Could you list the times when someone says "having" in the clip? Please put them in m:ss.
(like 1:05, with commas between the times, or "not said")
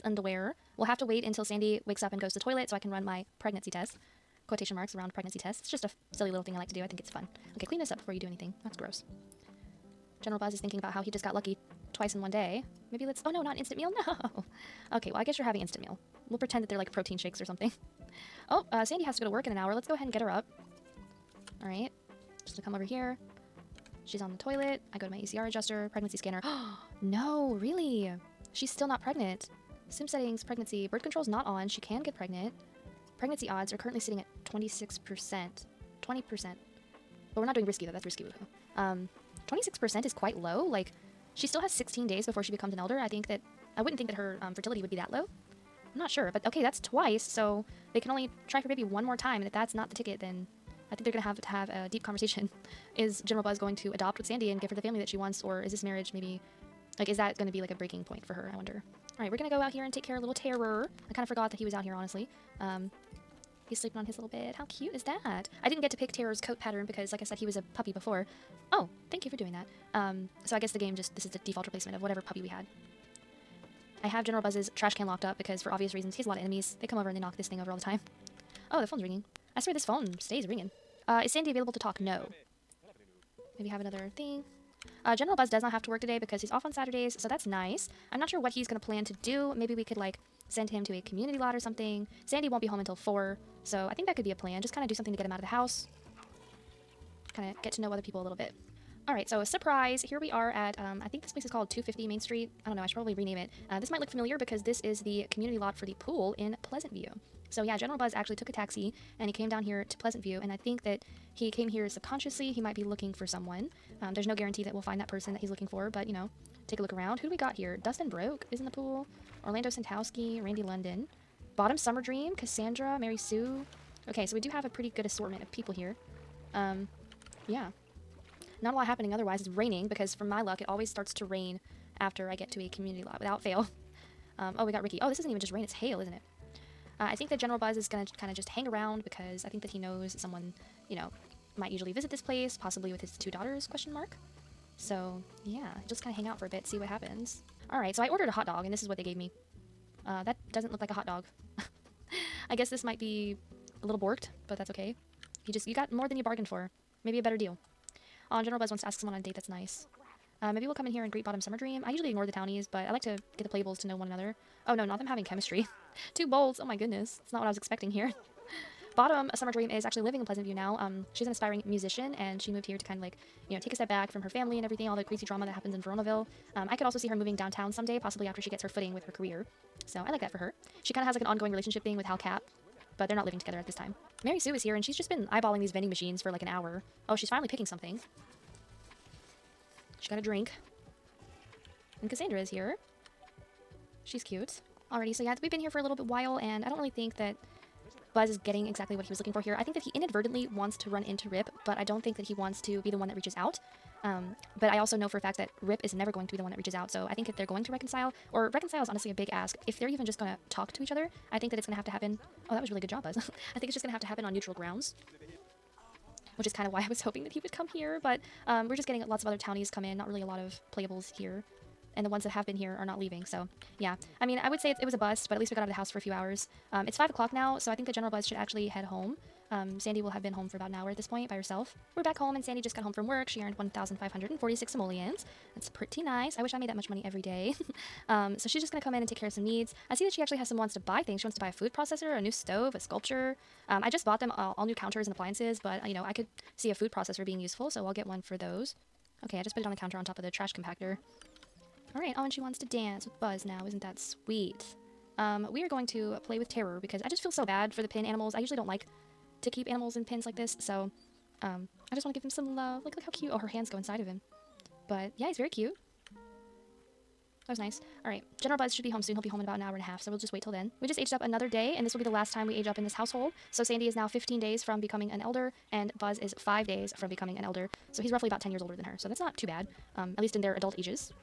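0:15, 2:45.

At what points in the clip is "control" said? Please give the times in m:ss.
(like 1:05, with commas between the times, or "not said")
0:31.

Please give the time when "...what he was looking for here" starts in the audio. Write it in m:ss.
3:18.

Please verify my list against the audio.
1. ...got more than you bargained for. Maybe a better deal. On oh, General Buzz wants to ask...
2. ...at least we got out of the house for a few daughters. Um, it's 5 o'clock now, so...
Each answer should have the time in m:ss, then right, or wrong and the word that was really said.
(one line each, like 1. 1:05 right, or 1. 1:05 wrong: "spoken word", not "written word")
1. 2:35 right
2. 3:45 wrong: "hours", not "daughters".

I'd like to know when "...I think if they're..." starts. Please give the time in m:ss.
3:27.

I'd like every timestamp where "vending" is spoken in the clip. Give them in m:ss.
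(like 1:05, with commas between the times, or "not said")
3:05.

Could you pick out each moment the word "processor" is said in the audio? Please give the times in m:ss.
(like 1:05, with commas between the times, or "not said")
4:01, 4:06.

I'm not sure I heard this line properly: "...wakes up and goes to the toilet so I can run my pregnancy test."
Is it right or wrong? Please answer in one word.
right.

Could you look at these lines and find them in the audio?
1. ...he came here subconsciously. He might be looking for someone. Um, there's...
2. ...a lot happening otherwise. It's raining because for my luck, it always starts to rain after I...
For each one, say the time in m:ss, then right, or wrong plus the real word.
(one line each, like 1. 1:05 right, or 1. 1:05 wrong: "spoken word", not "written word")
1. 1:51 right
2. 2:08 right.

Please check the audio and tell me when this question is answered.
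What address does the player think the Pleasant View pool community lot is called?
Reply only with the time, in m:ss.
1:41.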